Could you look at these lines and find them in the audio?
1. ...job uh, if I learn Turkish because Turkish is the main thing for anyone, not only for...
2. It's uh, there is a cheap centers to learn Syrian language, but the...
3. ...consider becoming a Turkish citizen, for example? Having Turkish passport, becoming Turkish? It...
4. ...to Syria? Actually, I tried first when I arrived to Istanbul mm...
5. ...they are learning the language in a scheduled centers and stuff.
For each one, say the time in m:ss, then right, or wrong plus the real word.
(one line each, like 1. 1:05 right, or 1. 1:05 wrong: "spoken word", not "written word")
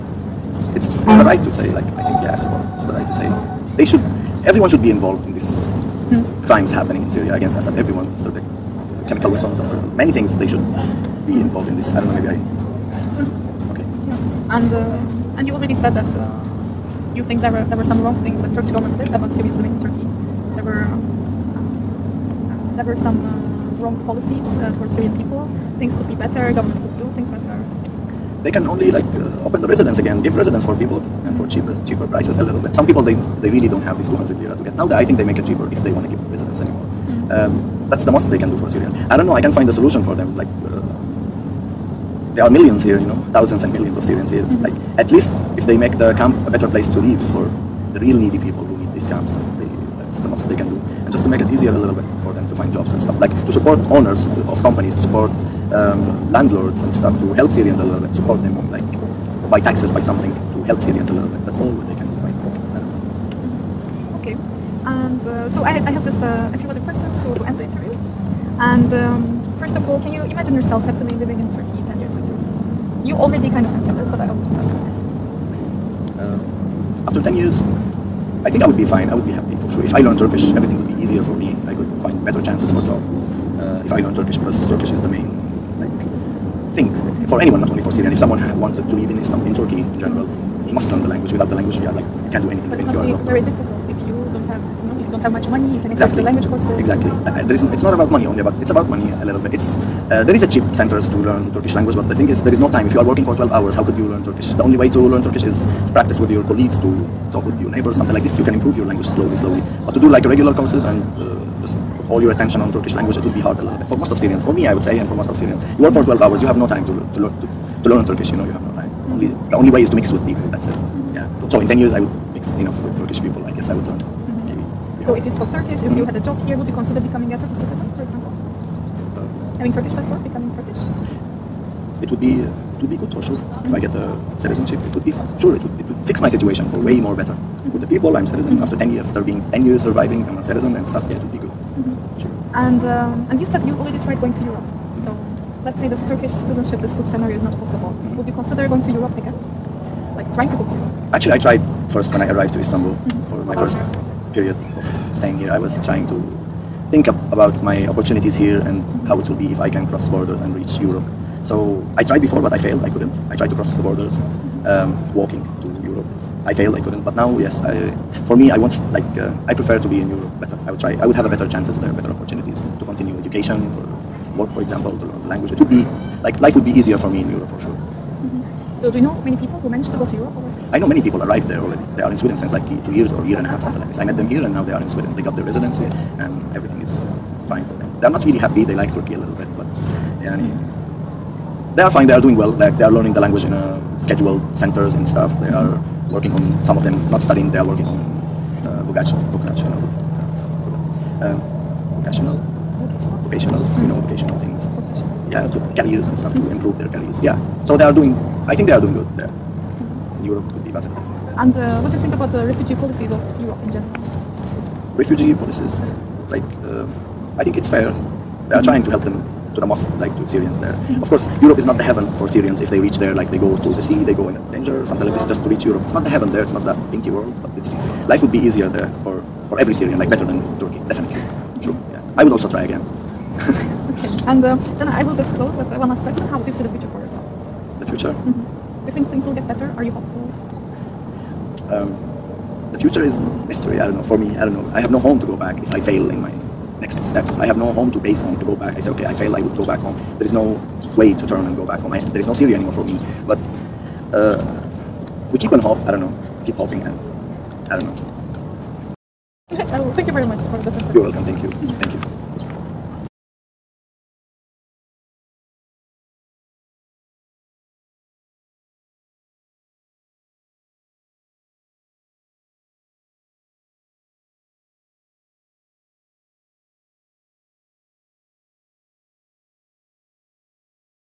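1. 1:22 right
2. 1:39 wrong: "Turkish", not "Syrian"
3. 2:06 right
4. 2:30 wrong: "Europe", not "Syria"
5. 3:12 right.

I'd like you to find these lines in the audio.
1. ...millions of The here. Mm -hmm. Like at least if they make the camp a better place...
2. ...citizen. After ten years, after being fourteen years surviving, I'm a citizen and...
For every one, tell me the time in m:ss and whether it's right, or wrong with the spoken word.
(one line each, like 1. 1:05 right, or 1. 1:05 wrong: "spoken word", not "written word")
1. 0:43 wrong: "Syrians", not "The"
2. 2:18 wrong: "ten", not "fourteen".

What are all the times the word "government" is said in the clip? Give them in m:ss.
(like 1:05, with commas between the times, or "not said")
0:18, 0:26.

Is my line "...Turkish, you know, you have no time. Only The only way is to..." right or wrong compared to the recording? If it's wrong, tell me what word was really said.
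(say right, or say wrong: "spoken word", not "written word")
right.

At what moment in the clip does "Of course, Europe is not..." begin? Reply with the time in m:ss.
3:41.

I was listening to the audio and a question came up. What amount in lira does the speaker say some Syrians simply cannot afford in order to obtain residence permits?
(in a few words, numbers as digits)
200 lira.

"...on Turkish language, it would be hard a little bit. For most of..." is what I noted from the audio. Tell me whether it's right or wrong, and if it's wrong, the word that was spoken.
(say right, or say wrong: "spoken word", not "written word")
right.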